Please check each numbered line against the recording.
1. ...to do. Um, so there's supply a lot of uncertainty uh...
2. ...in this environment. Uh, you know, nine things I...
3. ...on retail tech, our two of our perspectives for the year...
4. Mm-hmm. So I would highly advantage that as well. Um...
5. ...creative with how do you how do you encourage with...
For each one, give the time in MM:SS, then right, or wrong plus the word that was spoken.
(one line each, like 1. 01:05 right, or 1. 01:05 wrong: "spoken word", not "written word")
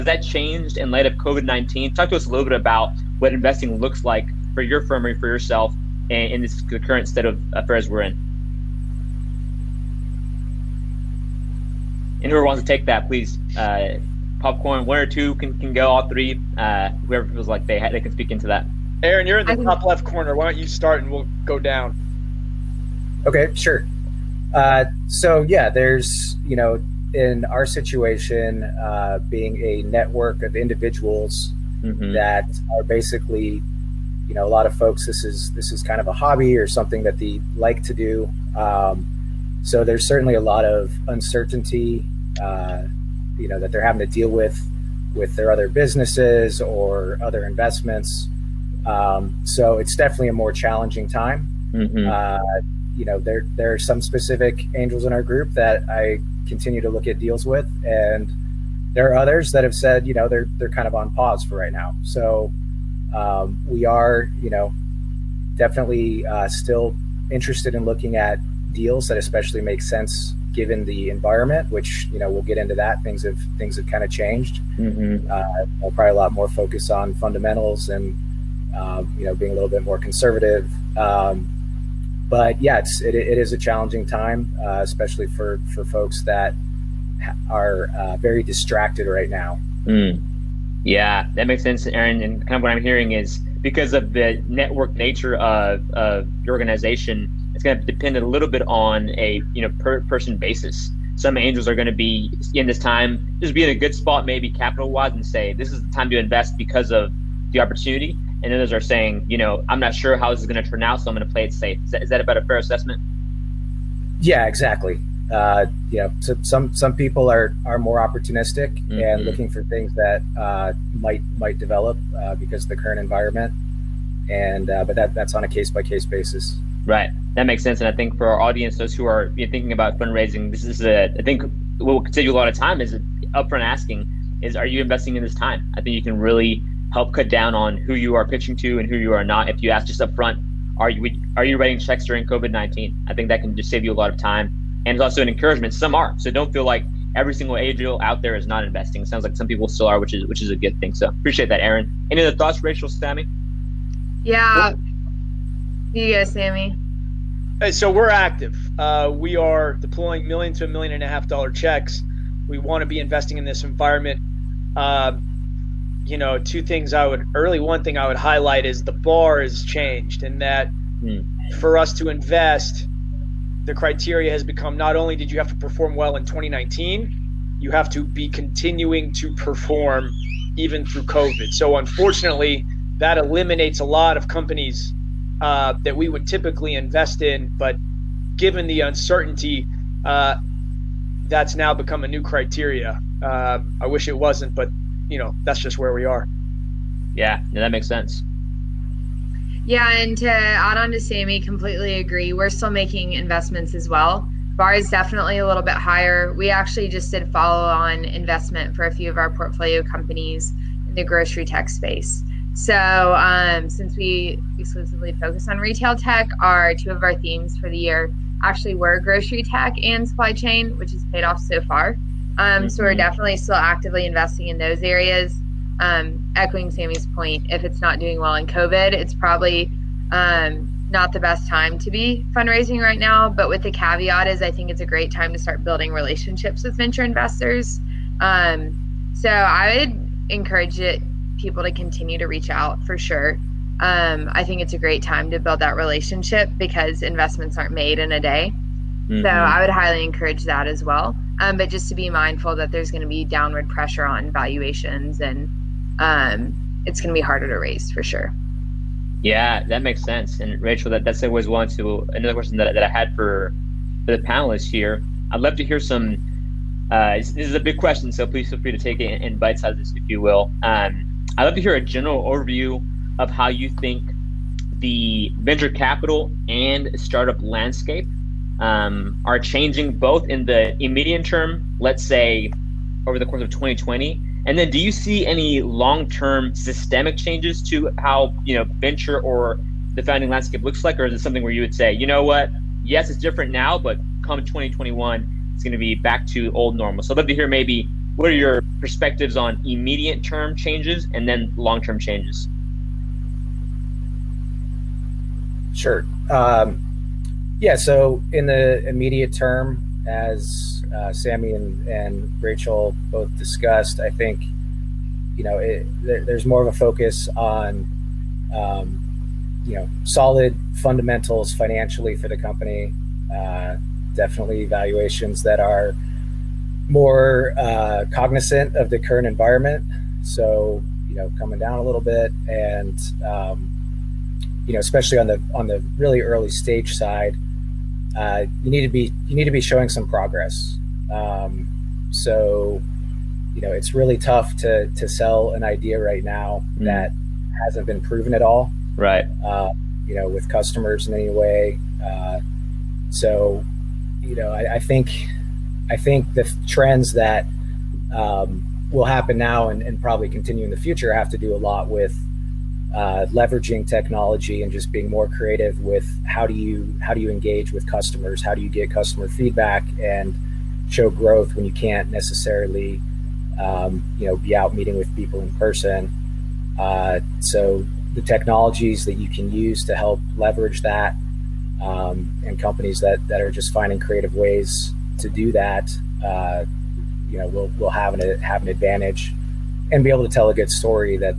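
1. 00:37 wrong: "certainly", not "supply"
2. 02:43 wrong: "two", not "nine"
3. 03:35 wrong: "themes", not "perspectives"
4. 04:09 wrong: "encourage", not "advantage"
5. 06:05 wrong: "engage", not "encourage".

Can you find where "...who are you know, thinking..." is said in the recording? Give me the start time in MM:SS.
02:08.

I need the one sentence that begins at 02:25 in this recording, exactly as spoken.
Some are, so don't feel like every single angel out there is not investing.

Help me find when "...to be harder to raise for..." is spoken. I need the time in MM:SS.
04:17.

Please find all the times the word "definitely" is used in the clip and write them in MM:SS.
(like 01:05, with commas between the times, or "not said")
00:49, 01:05, 03:24, 03:42, 05:24.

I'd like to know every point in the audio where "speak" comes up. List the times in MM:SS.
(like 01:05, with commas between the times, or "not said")
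00:18.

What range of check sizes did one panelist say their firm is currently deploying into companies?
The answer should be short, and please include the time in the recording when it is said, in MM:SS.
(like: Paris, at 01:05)
$1 million to $1.5 million, at 02:40.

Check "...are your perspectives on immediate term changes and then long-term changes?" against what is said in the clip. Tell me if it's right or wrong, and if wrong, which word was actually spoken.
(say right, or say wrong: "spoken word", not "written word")
right.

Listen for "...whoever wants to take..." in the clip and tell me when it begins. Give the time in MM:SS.
00:12.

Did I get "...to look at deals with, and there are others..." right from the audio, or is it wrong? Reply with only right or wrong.
right.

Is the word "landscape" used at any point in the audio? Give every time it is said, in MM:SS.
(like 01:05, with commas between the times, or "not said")
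04:37, 04:50.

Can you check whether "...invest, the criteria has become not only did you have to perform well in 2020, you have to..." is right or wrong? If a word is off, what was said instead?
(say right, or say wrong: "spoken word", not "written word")
wrong: "2019", not "2020".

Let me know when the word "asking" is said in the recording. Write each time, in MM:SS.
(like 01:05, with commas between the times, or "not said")
02:13.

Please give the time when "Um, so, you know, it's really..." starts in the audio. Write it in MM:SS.
05:41.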